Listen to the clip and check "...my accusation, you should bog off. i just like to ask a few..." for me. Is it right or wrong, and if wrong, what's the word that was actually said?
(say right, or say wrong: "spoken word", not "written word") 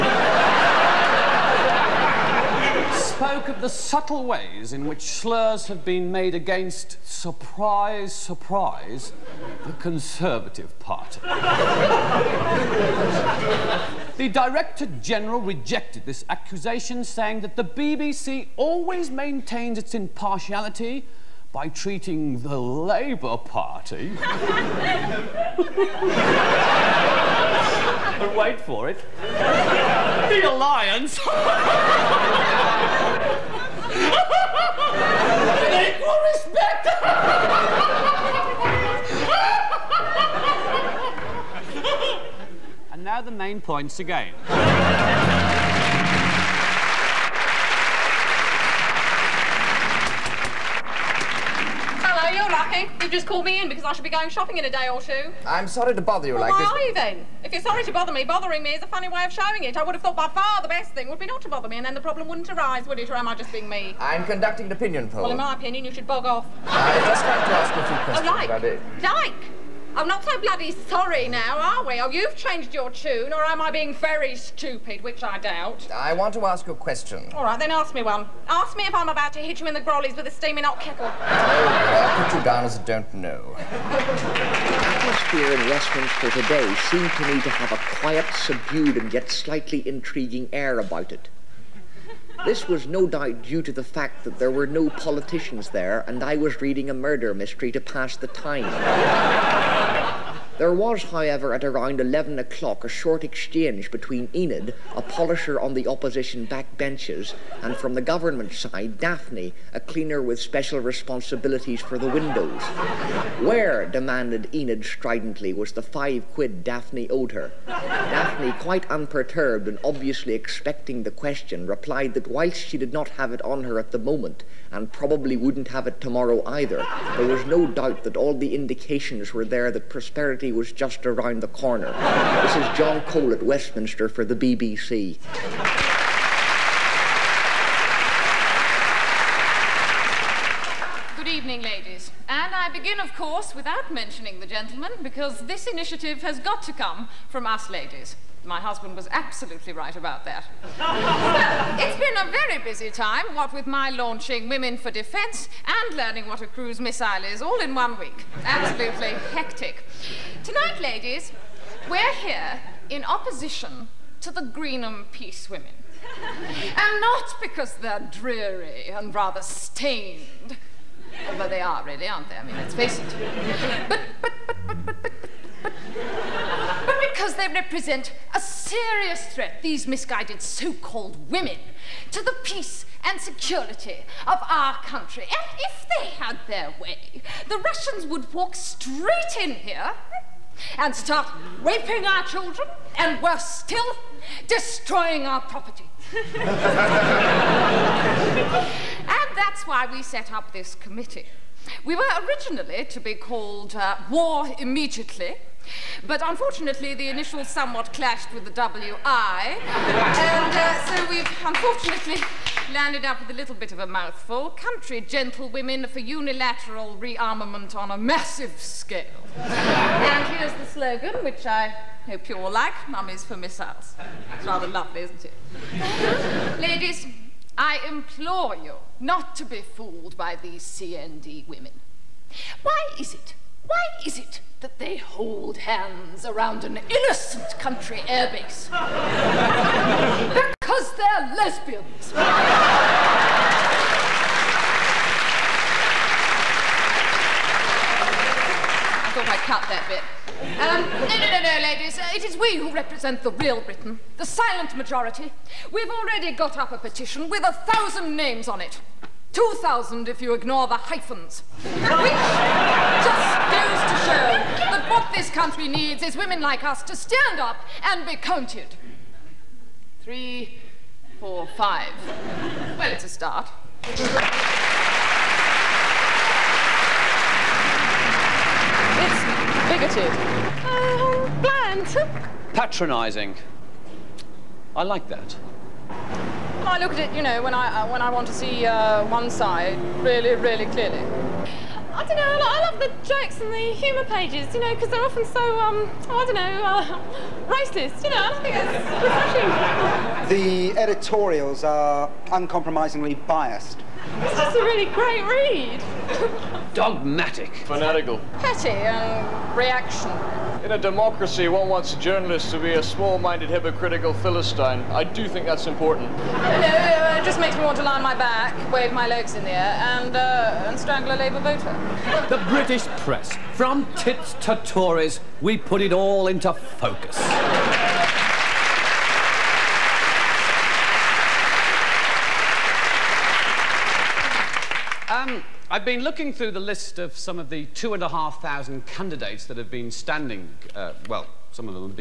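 wrong: "opinion", not "accusation".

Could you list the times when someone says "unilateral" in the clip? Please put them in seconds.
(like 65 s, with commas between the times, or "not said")
215 s.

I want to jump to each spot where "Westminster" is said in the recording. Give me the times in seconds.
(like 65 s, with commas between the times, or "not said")
85 s, 133 s.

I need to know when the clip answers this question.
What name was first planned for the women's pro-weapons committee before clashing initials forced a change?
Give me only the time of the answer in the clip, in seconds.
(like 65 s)
204 s.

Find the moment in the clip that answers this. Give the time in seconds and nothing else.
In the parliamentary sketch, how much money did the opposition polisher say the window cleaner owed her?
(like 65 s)
115 s.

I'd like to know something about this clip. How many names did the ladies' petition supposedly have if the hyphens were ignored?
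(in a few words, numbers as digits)
2000.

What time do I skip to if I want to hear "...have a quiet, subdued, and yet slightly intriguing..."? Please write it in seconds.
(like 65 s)
87 s.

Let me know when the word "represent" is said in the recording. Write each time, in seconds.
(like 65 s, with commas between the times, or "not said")
177 s, 252 s.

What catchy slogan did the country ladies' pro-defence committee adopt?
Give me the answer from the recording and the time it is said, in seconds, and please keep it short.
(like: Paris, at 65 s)
Mummies for Missiles, at 222 s.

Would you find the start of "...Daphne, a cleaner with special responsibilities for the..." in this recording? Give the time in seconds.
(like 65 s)
108 s.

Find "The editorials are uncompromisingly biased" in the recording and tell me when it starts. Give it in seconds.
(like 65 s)
300 s.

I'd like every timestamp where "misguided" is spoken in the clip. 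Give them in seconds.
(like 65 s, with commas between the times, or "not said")
179 s.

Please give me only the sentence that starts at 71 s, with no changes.
Or oh, you've changed your tune, or am I being very stupid, which I doubt.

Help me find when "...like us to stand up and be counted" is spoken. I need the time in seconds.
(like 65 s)
266 s.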